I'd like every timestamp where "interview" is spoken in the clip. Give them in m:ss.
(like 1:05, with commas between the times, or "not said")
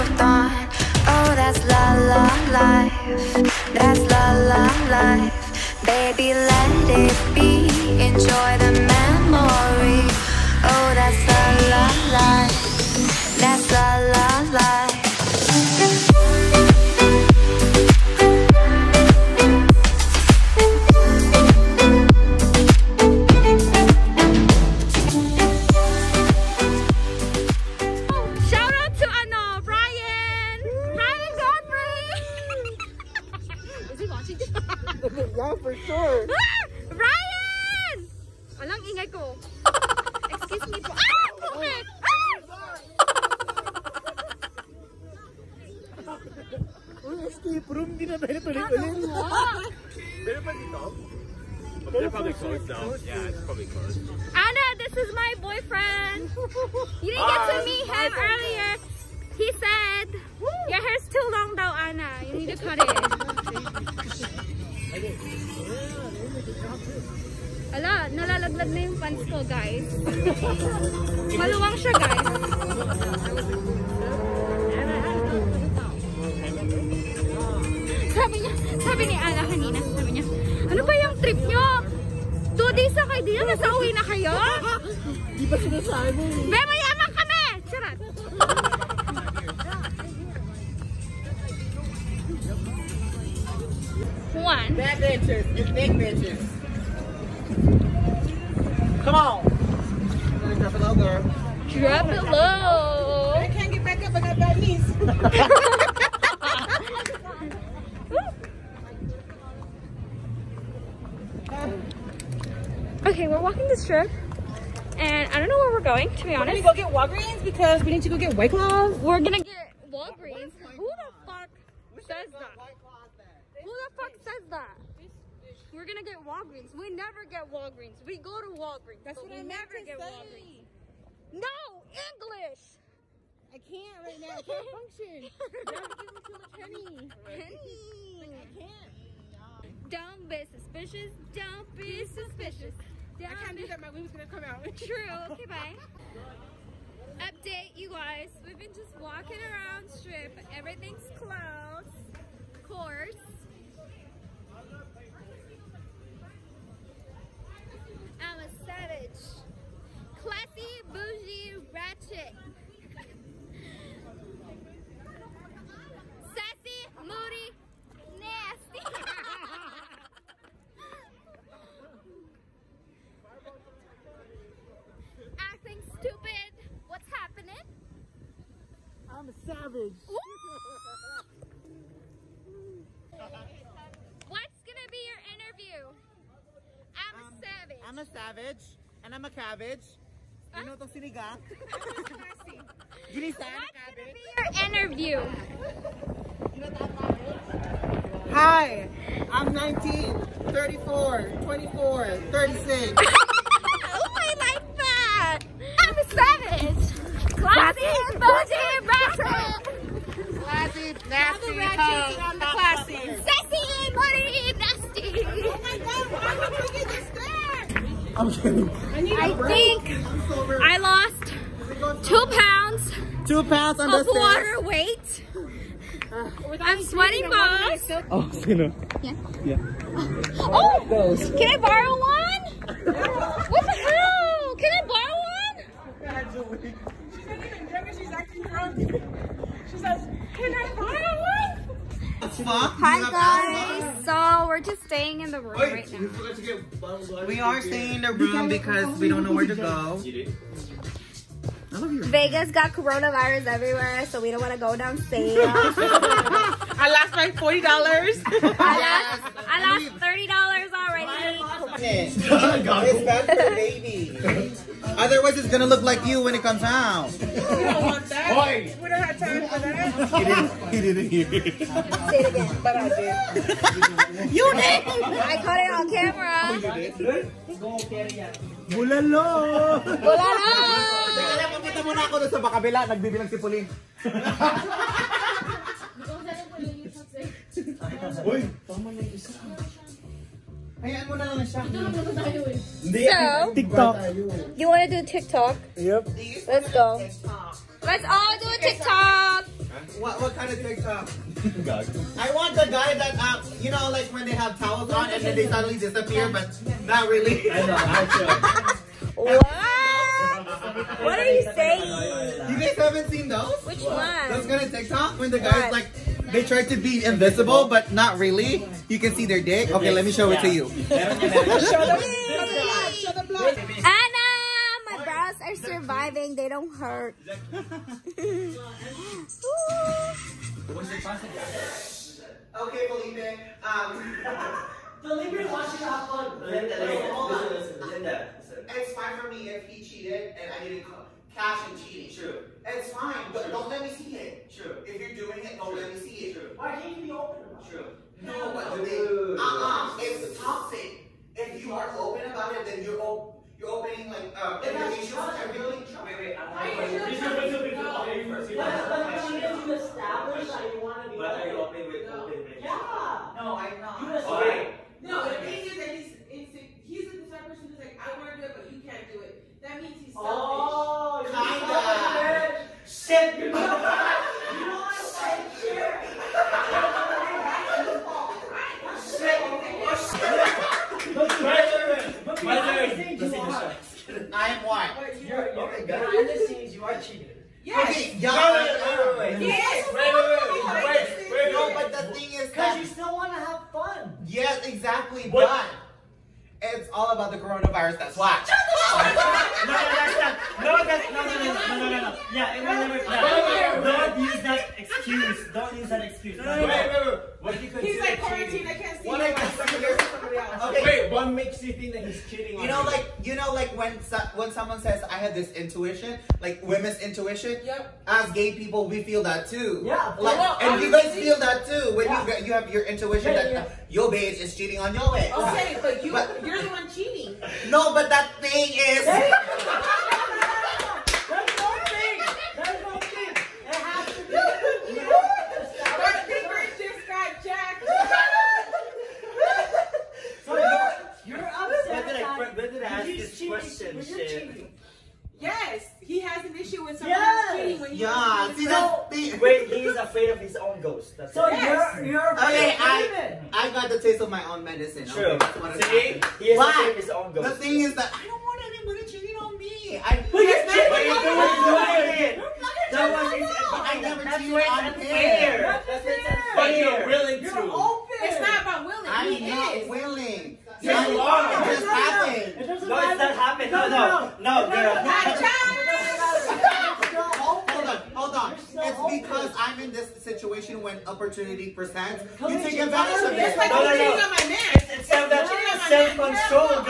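3:05, 3:14.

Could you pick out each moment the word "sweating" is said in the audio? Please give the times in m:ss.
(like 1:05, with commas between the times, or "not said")
3:46.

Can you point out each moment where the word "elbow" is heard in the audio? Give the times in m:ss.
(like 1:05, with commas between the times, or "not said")
not said.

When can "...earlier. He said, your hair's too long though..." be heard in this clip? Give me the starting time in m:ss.
0:58.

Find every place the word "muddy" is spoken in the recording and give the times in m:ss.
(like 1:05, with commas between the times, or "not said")
3:33.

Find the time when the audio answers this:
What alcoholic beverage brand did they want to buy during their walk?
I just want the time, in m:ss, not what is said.
1:58.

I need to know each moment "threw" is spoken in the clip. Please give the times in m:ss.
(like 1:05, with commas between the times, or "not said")
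not said.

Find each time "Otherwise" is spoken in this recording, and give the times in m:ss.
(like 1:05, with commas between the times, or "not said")
4:24.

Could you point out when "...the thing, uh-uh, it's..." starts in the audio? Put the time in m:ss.
5:48.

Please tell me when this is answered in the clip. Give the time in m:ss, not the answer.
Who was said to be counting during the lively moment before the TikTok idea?
4:43.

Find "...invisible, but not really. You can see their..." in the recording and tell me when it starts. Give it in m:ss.
5:17.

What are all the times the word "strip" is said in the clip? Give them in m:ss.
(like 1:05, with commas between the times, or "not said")
1:53, 2:29.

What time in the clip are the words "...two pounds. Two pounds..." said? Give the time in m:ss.
3:42.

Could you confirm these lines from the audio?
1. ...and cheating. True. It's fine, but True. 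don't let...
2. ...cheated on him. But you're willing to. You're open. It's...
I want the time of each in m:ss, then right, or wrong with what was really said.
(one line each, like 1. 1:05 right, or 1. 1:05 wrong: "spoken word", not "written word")
1. 5:41 right
2. 7:44 right.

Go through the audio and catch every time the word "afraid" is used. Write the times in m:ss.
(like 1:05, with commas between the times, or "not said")
7:29, 7:36.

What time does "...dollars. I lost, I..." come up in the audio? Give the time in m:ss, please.
4:17.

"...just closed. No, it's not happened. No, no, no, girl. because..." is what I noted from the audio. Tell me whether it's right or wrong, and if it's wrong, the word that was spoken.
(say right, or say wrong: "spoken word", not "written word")
wrong: "happened", not "closed".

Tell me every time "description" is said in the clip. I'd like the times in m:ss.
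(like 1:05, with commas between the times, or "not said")
not said.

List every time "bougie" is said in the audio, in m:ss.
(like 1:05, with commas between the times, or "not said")
2:40, 3:28.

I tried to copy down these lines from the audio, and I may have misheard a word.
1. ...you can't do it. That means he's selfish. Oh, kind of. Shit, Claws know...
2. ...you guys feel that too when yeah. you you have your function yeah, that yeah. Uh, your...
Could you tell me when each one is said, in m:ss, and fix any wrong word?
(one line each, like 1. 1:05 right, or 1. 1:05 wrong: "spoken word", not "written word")
1. 6:08 wrong: "You", not "Claws"
2. 7:00 wrong: "intuition", not "function".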